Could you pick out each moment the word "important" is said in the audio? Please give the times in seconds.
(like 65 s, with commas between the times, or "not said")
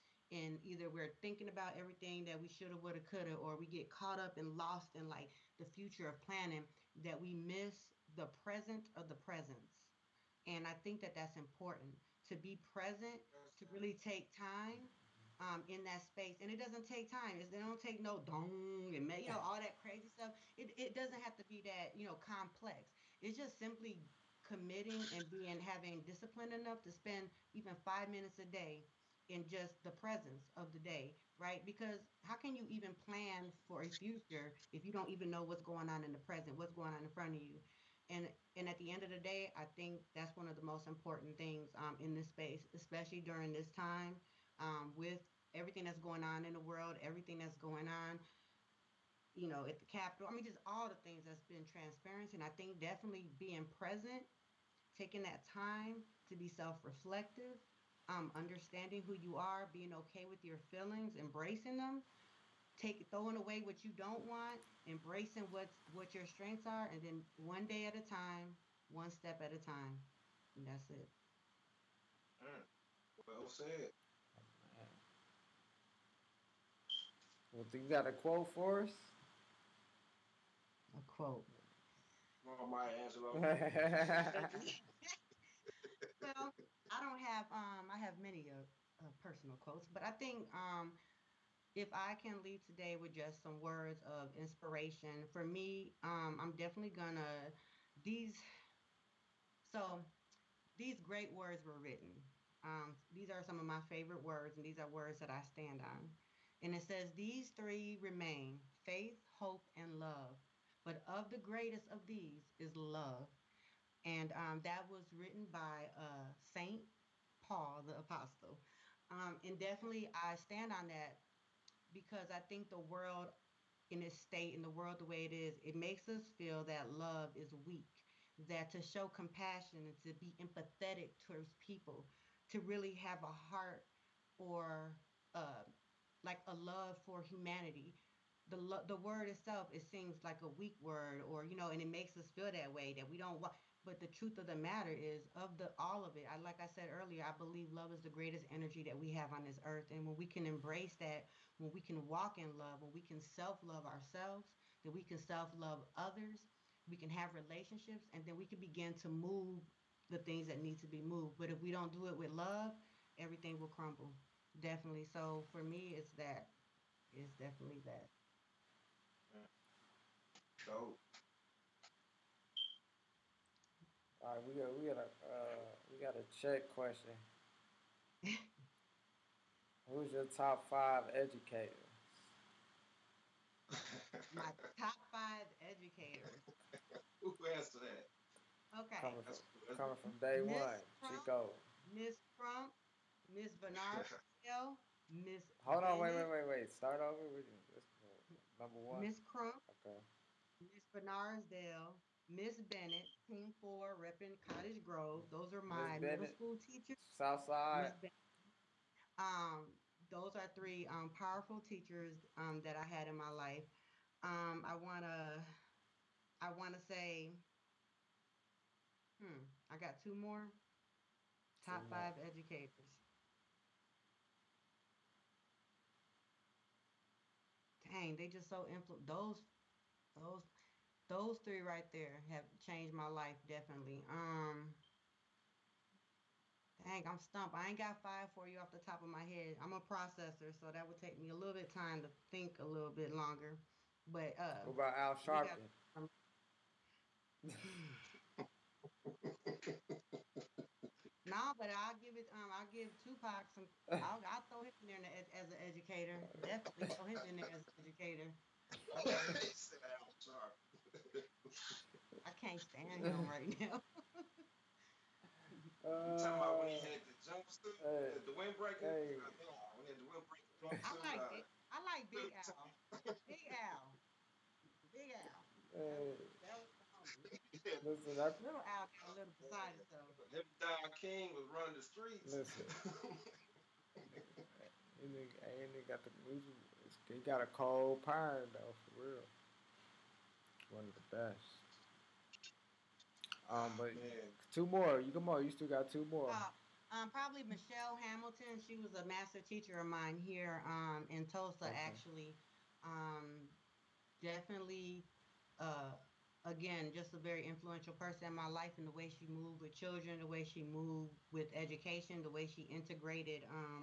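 11 s, 40 s.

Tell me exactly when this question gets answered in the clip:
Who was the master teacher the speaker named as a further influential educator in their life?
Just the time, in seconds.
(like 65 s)
297 s.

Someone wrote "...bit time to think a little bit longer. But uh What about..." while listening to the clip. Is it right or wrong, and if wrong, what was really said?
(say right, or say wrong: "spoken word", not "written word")
right.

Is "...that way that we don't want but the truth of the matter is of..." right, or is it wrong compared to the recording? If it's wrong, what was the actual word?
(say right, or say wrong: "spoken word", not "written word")
right.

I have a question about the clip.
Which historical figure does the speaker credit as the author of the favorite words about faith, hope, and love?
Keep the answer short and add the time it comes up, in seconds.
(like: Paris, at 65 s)
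Saint Paul the Apostle, at 116 s.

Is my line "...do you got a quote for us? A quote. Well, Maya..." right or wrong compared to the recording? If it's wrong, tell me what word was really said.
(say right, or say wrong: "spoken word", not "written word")
right.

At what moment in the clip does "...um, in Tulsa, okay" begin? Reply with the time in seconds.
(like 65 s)
300 s.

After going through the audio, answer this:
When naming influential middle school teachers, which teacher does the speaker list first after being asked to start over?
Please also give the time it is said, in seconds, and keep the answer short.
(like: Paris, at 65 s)
Miss Crump, at 199 s.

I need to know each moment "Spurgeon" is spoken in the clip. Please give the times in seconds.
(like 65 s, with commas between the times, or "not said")
not said.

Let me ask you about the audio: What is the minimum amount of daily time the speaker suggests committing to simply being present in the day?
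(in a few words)
5 minutes.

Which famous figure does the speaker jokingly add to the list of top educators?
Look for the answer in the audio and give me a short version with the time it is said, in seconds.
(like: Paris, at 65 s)
Tupac, at 253 s.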